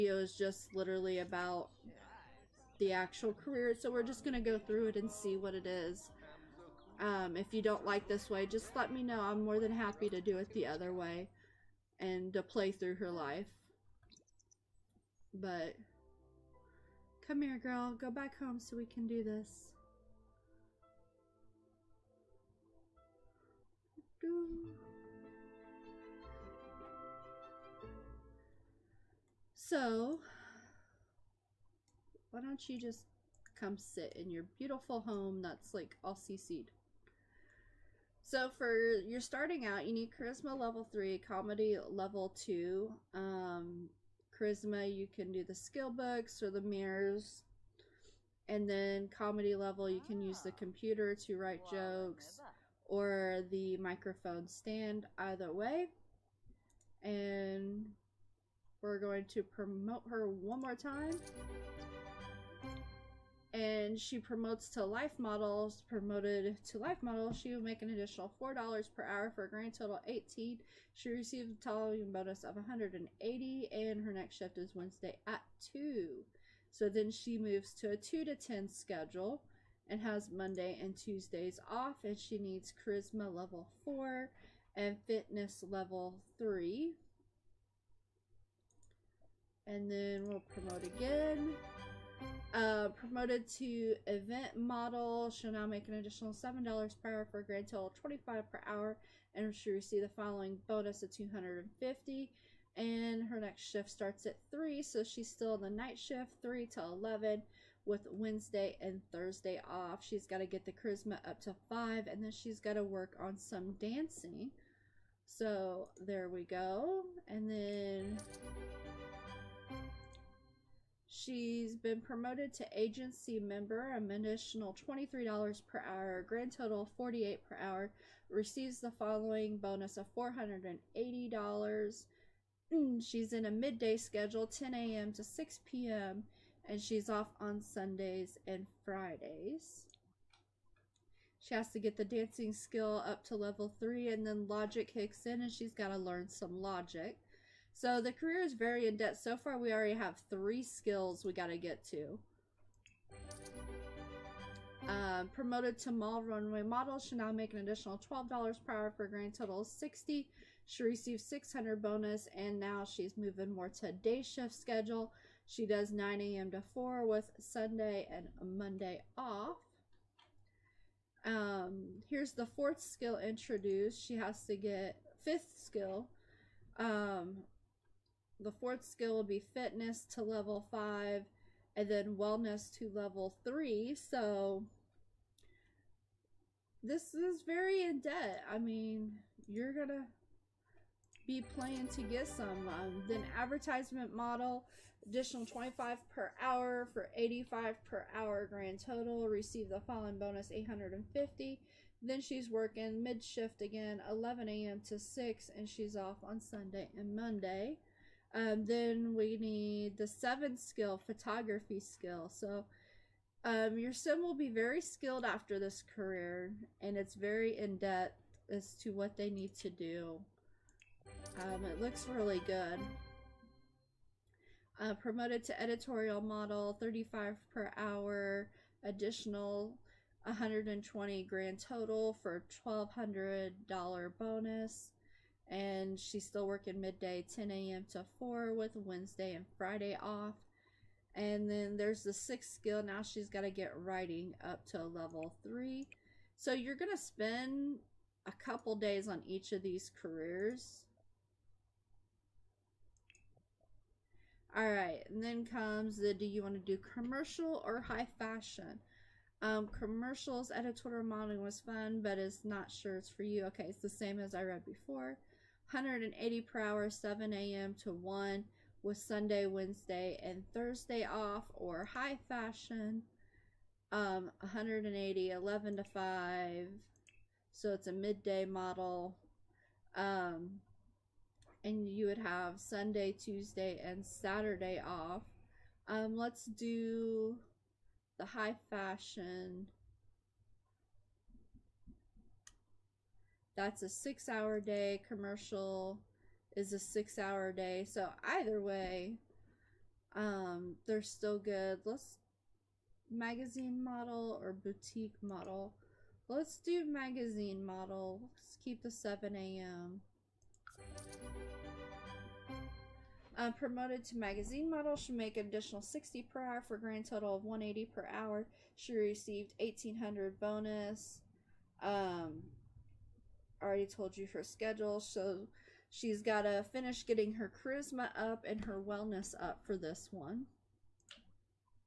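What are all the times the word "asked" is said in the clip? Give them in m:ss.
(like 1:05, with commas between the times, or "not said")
not said.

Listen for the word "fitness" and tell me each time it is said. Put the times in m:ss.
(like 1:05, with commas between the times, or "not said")
1:25, 2:59.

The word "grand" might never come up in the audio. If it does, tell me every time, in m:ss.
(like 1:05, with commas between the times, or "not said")
1:09, 1:37, 2:06, 2:39, 3:18, 3:51, 5:16.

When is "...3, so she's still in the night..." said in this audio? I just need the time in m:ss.
1:44.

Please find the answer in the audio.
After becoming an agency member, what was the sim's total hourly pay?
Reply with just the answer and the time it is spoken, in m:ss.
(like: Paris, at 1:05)
$48, at 2:06.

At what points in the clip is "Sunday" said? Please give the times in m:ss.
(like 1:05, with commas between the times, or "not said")
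2:17, 2:47, 3:26, 4:28, 4:42.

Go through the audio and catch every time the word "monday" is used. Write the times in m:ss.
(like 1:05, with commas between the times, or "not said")
1:20, 2:48, 3:27.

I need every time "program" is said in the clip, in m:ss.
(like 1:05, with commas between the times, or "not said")
not said.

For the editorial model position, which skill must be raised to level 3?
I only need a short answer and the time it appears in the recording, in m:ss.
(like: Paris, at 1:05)
writing, at 4:03.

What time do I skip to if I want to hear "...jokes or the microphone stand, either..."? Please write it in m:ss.
0:51.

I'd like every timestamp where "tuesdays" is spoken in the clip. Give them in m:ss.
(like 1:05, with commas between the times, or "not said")
1:20, 4:43.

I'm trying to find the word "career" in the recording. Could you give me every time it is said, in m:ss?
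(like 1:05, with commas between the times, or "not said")
0:03, 2:28, 3:35, 4:09.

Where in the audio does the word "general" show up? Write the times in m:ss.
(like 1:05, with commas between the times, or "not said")
not said.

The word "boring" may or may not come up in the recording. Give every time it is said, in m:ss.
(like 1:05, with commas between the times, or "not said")
not said.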